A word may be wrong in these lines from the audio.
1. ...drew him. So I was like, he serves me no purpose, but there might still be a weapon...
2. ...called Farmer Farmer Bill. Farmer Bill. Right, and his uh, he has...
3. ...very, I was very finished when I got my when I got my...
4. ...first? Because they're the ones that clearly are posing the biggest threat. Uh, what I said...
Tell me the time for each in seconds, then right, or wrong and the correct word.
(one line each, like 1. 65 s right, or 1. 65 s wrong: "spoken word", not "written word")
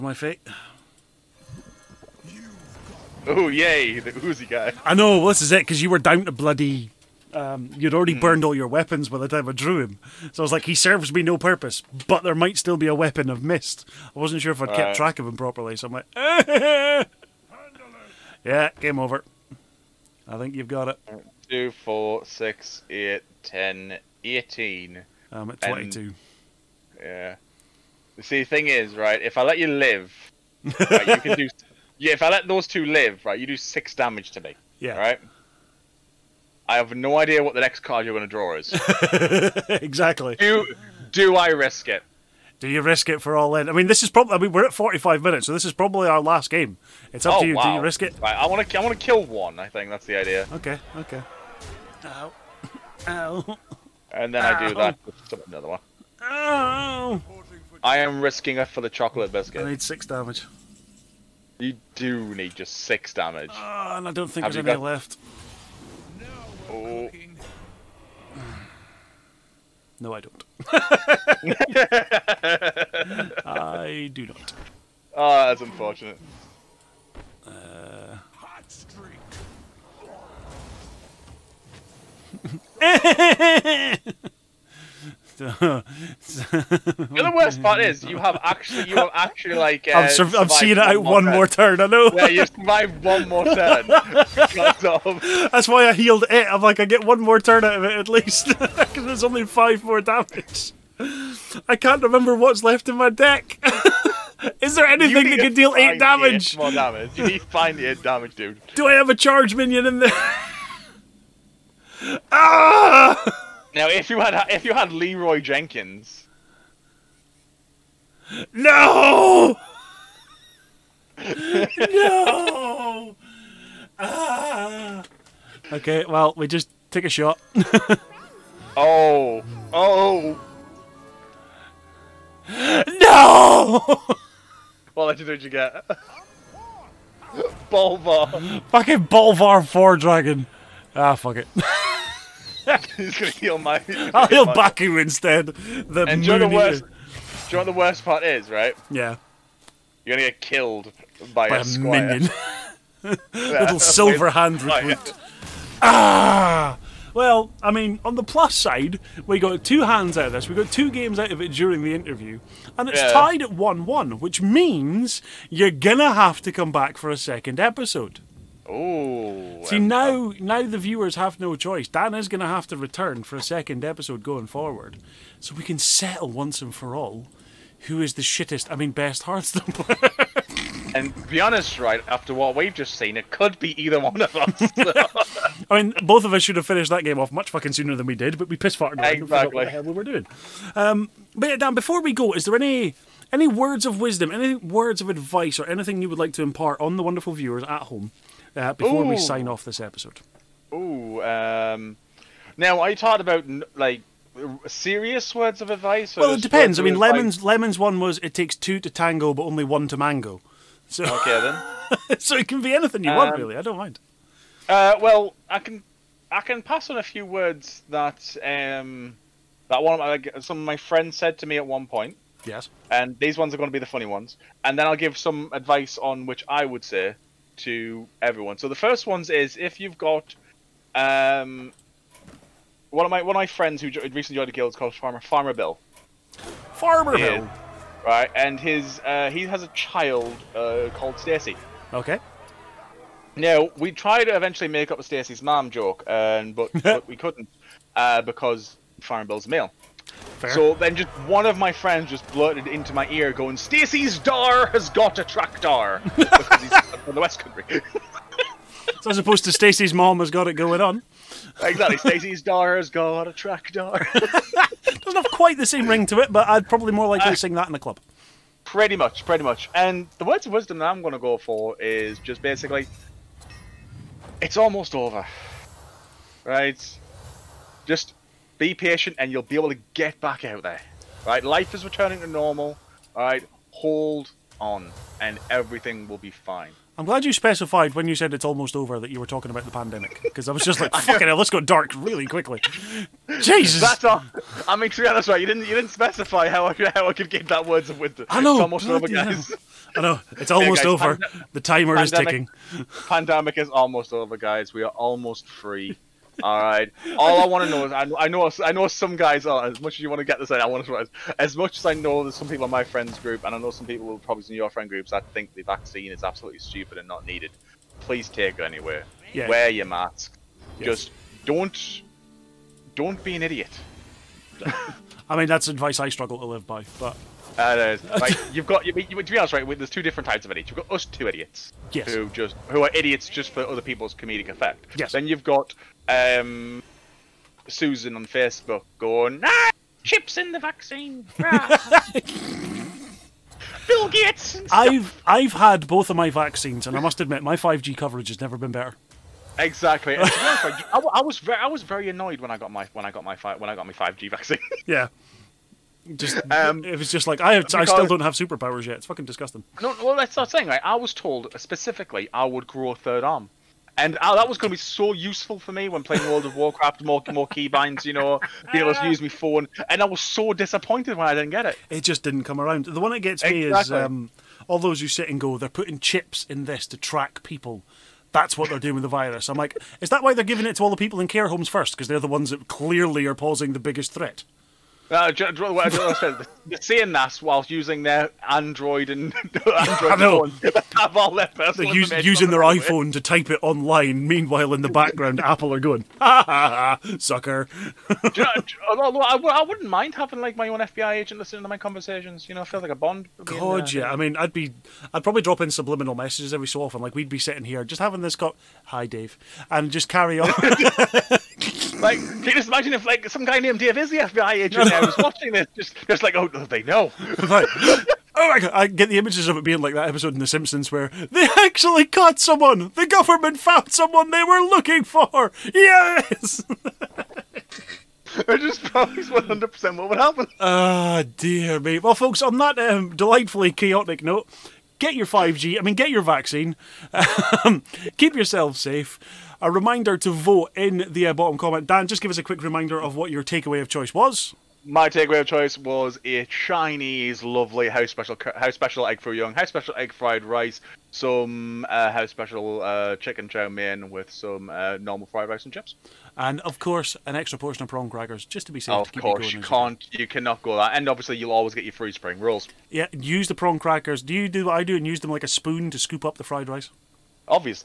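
1. 9 s right
2. 234 s right
3. 351 s wrong: "annoyed", not "finished"
4. 381 s right.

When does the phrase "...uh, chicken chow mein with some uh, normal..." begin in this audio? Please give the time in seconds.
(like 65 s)
452 s.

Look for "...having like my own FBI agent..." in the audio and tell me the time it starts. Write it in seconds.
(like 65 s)
400 s.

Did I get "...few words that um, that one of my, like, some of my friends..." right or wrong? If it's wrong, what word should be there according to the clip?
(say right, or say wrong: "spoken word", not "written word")
right.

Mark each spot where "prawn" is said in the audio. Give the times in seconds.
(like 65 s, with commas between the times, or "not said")
457 s, 463 s.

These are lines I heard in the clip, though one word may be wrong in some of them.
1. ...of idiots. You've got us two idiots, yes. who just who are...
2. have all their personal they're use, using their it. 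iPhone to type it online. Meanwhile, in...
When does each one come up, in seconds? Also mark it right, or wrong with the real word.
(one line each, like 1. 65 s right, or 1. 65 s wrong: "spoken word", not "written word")
1. 330 s right
2. 390 s right.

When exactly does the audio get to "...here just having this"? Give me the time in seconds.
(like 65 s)
407 s.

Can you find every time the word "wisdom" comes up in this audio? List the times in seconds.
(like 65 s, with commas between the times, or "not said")
193 s, 270 s, 297 s.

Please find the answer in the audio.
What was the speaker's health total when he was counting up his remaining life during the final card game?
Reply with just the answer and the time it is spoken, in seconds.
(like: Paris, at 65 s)
22, at 25 s.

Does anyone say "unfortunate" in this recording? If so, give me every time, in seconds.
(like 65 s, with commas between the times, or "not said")
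75 s.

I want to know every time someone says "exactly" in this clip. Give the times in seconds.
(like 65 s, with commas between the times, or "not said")
39 s, 189 s, 261 s, 349 s, 373 s.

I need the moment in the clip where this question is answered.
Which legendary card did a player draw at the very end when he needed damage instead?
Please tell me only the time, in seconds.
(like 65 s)
139 s.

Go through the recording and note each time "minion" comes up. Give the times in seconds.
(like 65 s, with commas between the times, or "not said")
109 s, 151 s.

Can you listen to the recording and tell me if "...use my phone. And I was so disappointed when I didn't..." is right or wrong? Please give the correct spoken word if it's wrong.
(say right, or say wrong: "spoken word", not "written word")
right.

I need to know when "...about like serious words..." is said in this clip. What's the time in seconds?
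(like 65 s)
203 s.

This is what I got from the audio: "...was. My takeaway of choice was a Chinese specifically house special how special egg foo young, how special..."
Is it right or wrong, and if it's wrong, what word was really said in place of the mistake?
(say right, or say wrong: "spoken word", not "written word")
wrong: "lovely", not "specifically".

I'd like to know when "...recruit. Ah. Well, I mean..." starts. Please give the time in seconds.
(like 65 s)
154 s.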